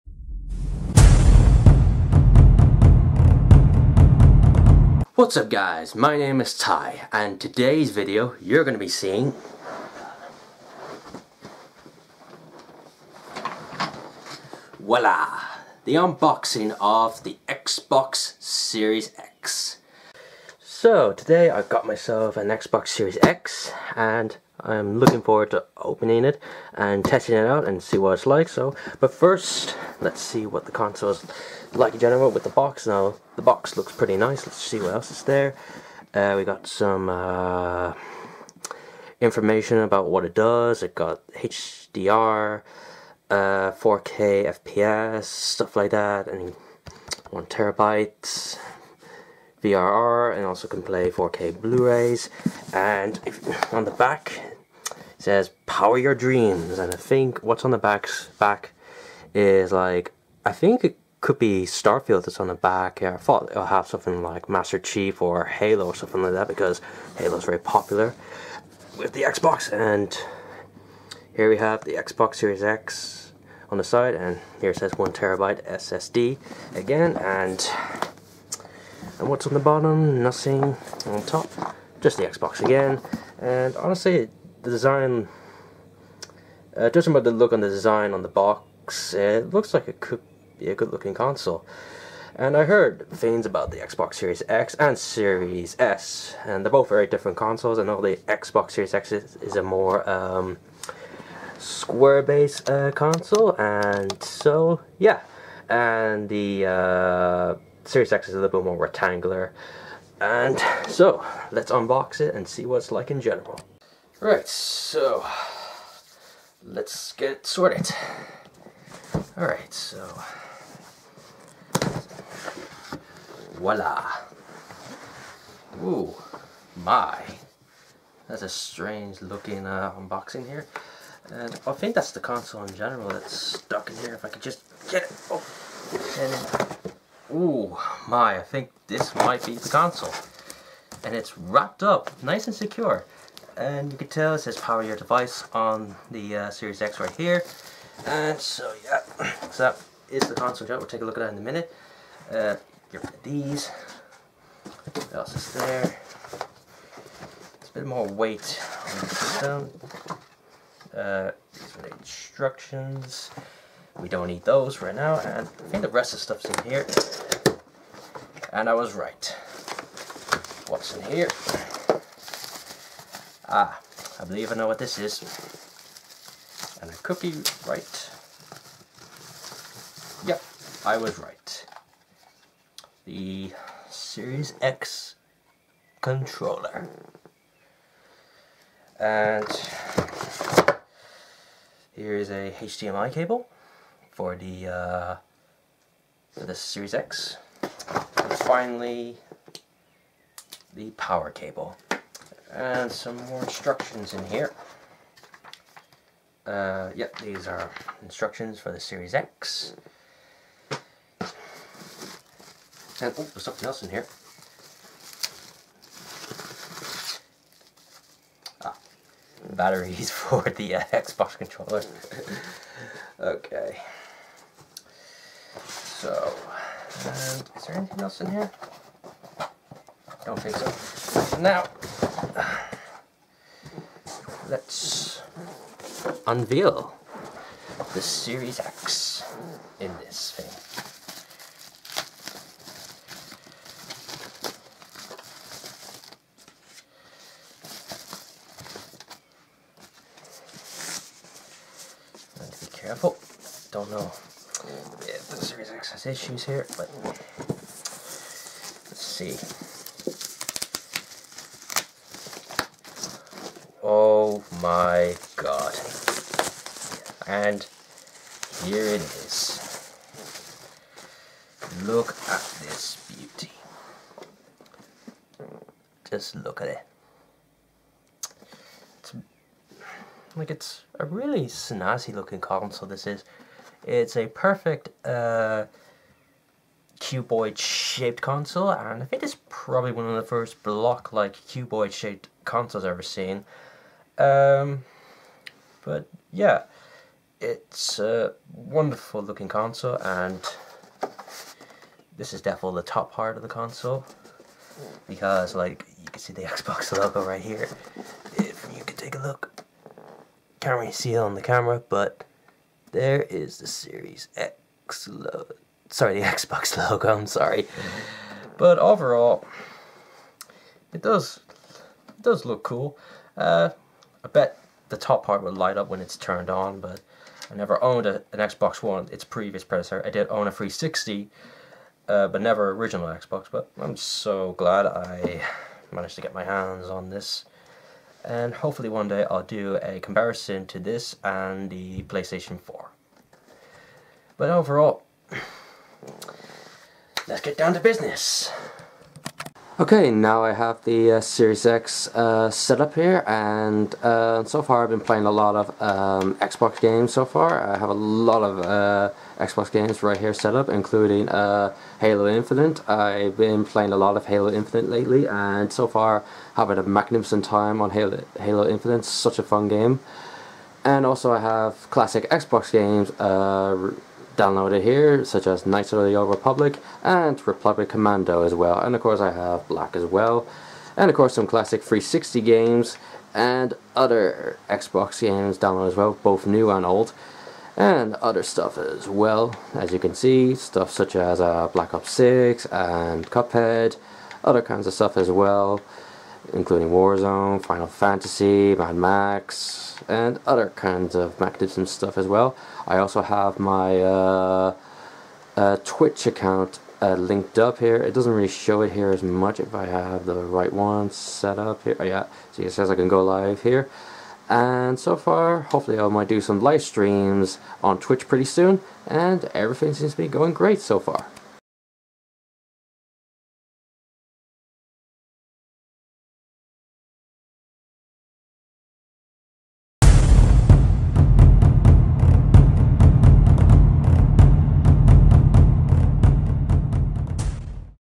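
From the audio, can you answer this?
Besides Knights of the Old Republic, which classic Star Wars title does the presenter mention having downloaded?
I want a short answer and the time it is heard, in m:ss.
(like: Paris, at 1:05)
Republic Commando, at 6:17.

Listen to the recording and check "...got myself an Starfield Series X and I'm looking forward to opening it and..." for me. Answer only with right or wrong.
wrong.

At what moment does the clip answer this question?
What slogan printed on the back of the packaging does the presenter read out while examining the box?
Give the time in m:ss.
0:55.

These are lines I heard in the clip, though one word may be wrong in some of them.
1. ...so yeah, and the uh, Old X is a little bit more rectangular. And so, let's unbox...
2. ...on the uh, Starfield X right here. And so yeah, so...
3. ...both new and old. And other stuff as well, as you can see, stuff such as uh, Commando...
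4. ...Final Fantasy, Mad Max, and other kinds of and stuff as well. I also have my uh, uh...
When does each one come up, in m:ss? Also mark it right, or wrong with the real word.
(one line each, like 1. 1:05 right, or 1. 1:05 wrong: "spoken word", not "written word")
1. 1:44 wrong: "Series", not "Old"
2. 2:25 wrong: "Series", not "Starfield"
3. 6:26 wrong: "Black", not "Commando"
4. 6:37 right.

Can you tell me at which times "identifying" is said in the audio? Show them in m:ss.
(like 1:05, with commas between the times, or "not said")
not said.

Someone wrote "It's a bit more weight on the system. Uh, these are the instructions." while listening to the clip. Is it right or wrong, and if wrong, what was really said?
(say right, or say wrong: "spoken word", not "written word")
right.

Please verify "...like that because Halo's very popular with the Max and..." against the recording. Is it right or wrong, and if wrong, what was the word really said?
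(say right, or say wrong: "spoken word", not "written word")
wrong: "Xbox", not "Max".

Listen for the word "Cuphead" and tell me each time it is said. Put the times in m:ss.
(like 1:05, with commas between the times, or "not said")
6:33.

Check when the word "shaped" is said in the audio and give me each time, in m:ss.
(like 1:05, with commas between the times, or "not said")
4:47, 4:51.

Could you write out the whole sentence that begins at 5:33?
But I'm so glad I managed to get my hands on this.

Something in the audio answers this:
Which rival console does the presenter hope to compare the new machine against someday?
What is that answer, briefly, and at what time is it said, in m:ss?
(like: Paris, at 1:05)
PlayStation 4, at 5:42.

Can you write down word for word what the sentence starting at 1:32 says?
And I heard things about the Xbox Series X and Series S, and they're both very different consoles.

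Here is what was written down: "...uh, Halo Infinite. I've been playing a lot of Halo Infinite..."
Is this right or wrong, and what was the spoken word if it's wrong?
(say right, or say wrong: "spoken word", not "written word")
right.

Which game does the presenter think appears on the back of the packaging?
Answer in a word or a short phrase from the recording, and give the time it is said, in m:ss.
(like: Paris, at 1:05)
Starfield, at 1:01.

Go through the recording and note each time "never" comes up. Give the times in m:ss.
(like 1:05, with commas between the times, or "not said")
5:27, 5:32.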